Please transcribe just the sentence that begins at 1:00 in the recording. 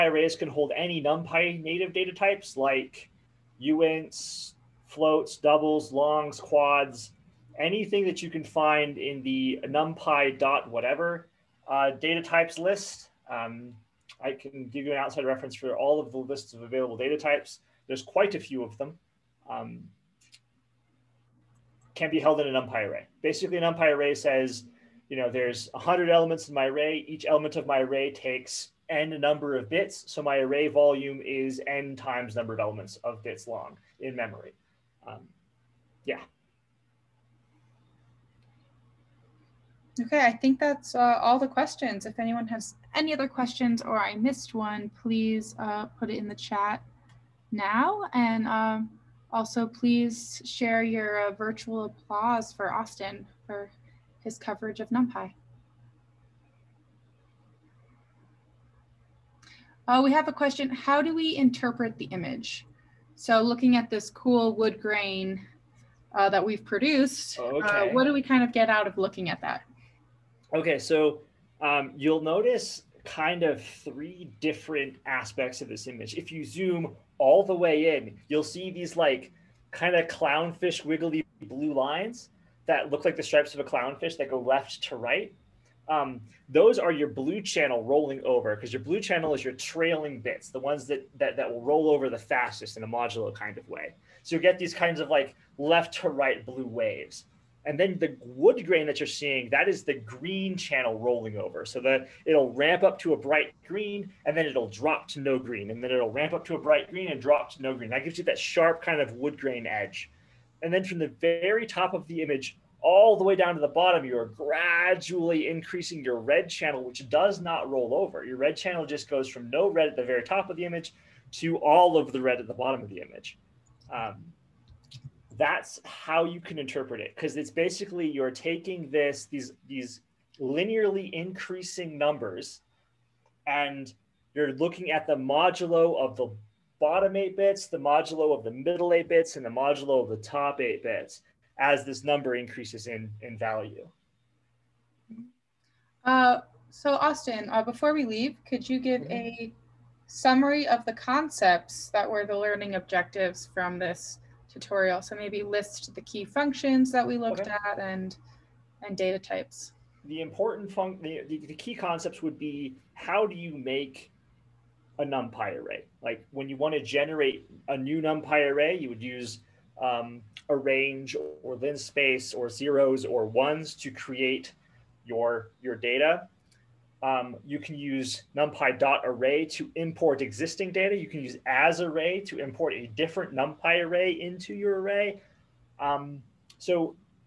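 How do we interpret the image?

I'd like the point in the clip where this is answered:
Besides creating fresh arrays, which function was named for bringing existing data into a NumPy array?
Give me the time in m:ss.
2:58.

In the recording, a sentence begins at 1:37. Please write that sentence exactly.
And then the wood grain that you're seeing, that is the green channel rolling over.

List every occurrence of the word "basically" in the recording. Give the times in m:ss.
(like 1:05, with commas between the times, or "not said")
0:23, 2:07.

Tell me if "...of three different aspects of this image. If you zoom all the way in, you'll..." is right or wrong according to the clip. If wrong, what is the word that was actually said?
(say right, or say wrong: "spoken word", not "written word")
right.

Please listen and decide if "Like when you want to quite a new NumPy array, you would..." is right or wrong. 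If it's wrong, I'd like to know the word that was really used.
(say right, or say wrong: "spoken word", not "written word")
wrong: "generate", not "quite".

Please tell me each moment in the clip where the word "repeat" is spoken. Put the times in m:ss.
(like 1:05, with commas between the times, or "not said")
not said.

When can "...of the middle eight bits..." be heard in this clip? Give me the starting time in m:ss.
2:18.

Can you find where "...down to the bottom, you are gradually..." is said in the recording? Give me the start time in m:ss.
1:53.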